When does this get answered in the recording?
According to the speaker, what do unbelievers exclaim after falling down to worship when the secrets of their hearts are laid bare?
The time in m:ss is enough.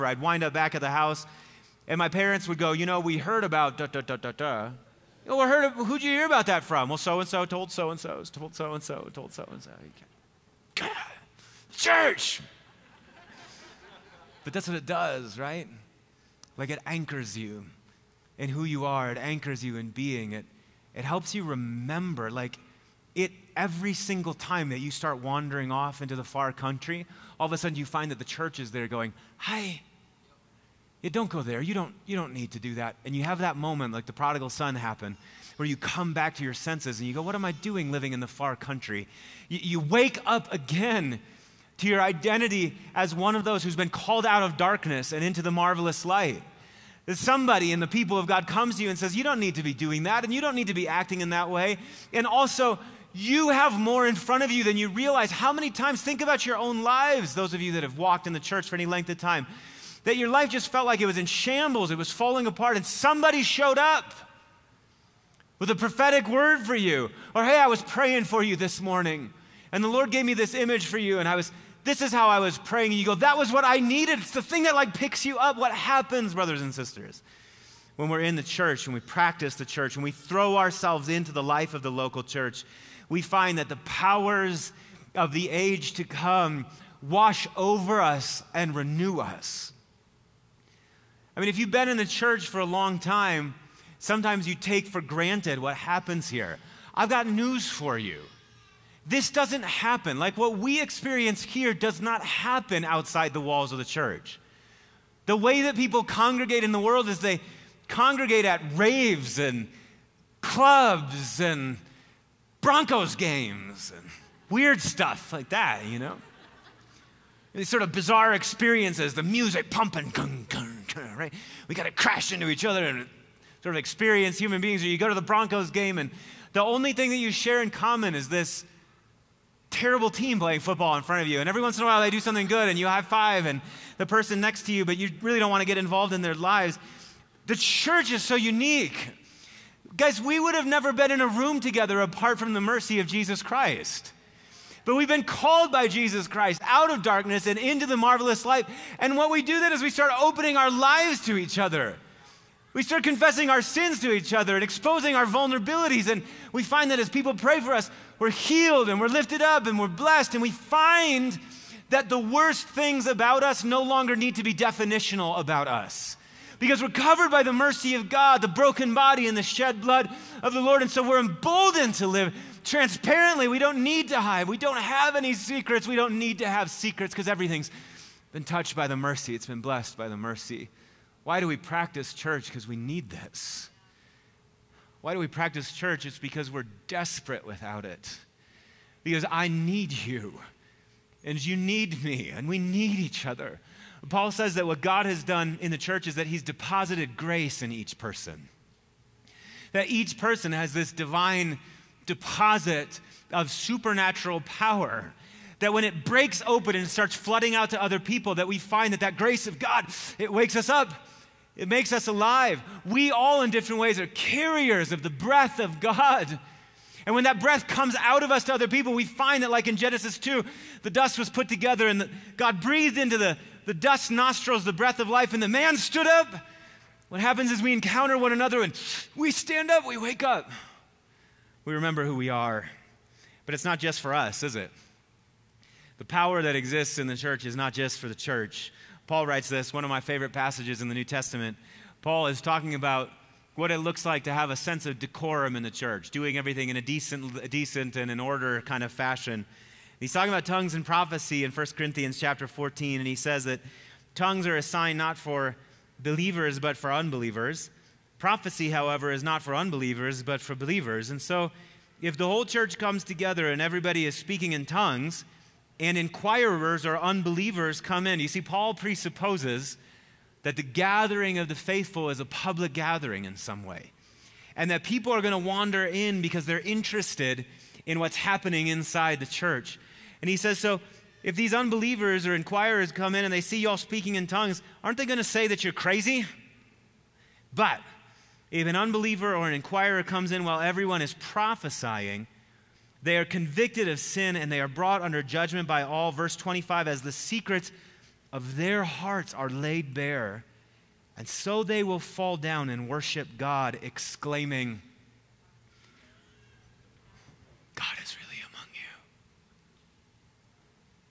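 5:07.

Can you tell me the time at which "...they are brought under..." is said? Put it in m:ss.
4:54.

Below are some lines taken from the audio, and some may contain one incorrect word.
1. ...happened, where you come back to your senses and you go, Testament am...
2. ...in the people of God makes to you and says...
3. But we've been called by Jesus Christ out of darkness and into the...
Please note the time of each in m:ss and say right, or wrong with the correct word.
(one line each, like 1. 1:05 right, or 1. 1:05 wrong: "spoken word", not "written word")
1. 0:34 wrong: "What", not "Testament"
2. 0:47 wrong: "comes", not "makes"
3. 2:24 right.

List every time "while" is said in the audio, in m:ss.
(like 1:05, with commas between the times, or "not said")
2:11, 4:50.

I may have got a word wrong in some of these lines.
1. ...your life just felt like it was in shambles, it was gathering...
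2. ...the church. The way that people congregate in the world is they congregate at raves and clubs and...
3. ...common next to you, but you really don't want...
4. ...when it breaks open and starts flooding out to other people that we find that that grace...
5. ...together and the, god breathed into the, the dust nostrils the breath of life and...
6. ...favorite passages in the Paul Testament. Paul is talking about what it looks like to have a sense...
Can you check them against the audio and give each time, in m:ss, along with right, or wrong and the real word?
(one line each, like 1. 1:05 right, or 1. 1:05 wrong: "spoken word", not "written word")
1. 1:00 wrong: "falling", not "gathering"
2. 1:43 right
3. 2:14 wrong: "person", not "common"
4. 3:25 right
5. 3:41 right
6. 4:00 wrong: "New", not "Paul".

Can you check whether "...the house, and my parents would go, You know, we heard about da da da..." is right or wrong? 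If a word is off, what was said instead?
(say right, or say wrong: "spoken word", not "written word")
right.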